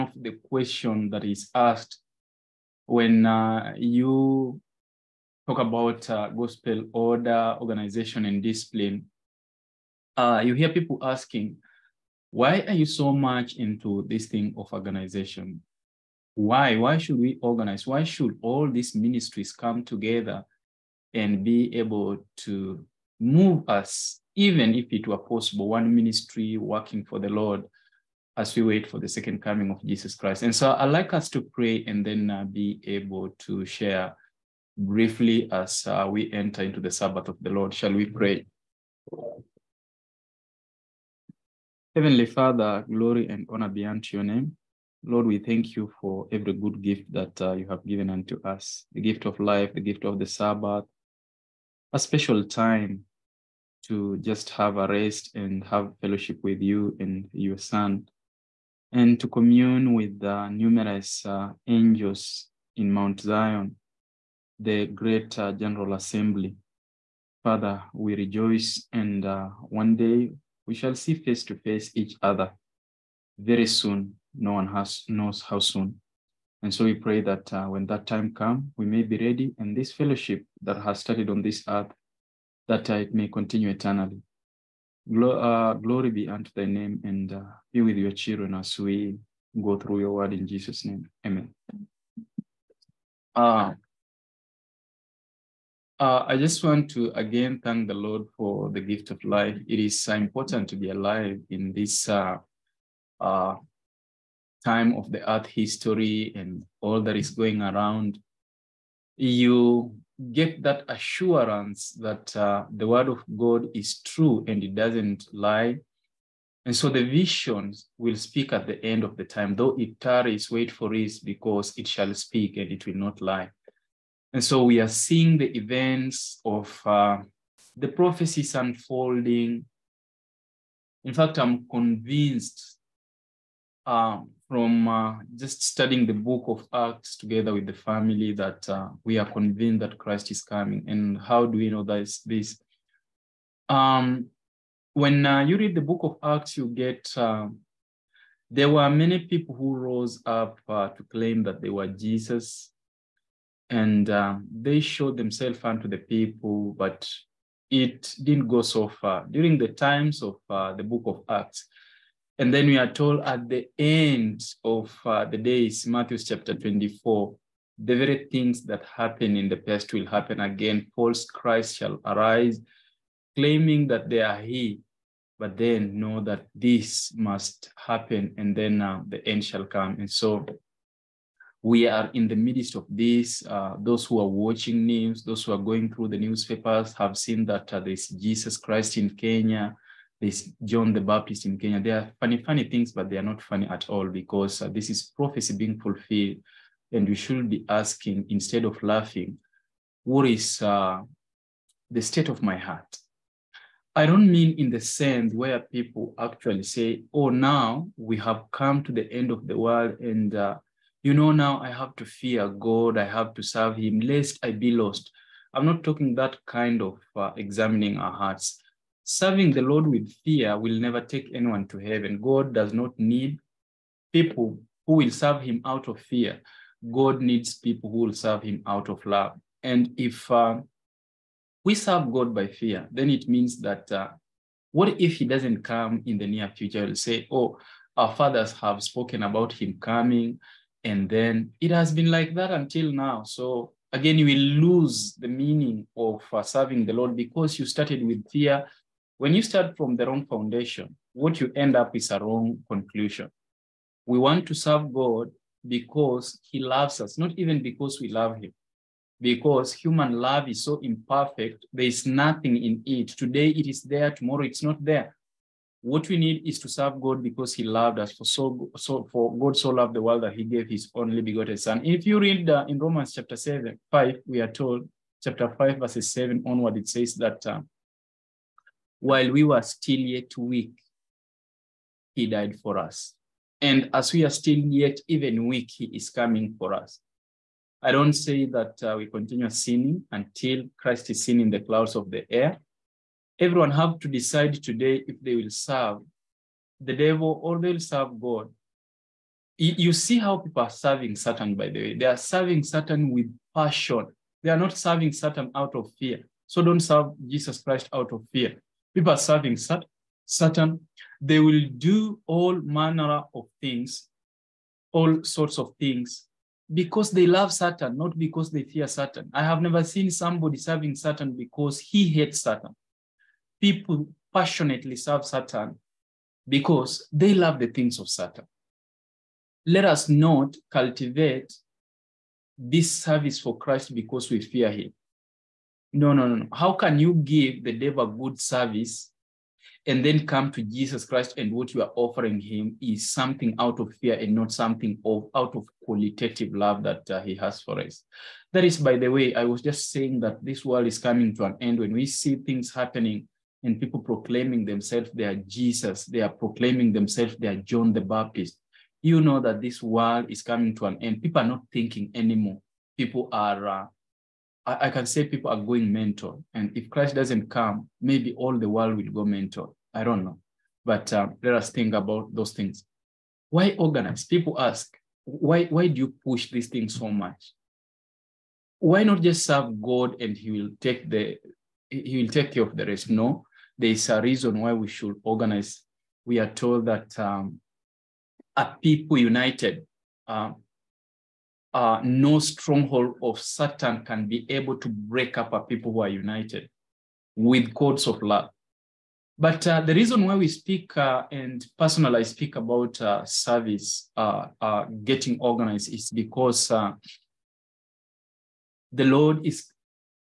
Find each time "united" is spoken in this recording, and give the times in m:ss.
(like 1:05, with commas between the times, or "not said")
6:29, 6:36.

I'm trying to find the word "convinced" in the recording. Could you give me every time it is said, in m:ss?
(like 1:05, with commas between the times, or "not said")
2:11, 2:19.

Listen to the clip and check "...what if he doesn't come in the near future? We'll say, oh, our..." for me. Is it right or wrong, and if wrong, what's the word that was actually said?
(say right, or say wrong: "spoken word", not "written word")
right.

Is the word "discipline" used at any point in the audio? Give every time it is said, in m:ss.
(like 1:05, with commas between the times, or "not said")
0:08.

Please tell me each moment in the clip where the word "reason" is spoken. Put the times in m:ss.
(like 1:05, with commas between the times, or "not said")
6:24, 6:39.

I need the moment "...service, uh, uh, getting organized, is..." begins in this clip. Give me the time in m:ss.
6:43.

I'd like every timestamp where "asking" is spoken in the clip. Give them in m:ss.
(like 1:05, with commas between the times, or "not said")
0:11, 3:17.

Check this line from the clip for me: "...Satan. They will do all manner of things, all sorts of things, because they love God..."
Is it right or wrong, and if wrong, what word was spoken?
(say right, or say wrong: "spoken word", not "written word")
wrong: "Satan", not "God".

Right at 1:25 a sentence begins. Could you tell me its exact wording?
Glo- uh, glory be unto thy name, and uh, be with your children as we go through your word in Jesus' name.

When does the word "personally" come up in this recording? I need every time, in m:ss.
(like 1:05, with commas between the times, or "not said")
6:41.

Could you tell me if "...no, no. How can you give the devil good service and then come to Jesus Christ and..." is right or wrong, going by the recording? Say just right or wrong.
right.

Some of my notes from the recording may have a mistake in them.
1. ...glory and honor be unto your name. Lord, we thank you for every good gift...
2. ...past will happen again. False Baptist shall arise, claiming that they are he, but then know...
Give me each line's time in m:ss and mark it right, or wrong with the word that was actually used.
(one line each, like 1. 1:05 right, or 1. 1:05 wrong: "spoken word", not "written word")
1. 0:42 right
2. 2:49 wrong: "Christ", not "Baptist".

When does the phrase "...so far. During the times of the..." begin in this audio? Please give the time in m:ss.
2:38.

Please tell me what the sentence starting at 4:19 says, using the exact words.
Because human love is so imperfect, there is nothing in it.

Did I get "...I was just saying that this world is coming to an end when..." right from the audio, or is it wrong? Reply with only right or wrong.
right.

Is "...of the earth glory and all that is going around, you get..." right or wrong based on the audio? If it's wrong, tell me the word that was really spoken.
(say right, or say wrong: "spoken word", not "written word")
wrong: "history", not "glory".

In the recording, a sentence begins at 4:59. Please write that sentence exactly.
You see how people are serving Satan, by the way.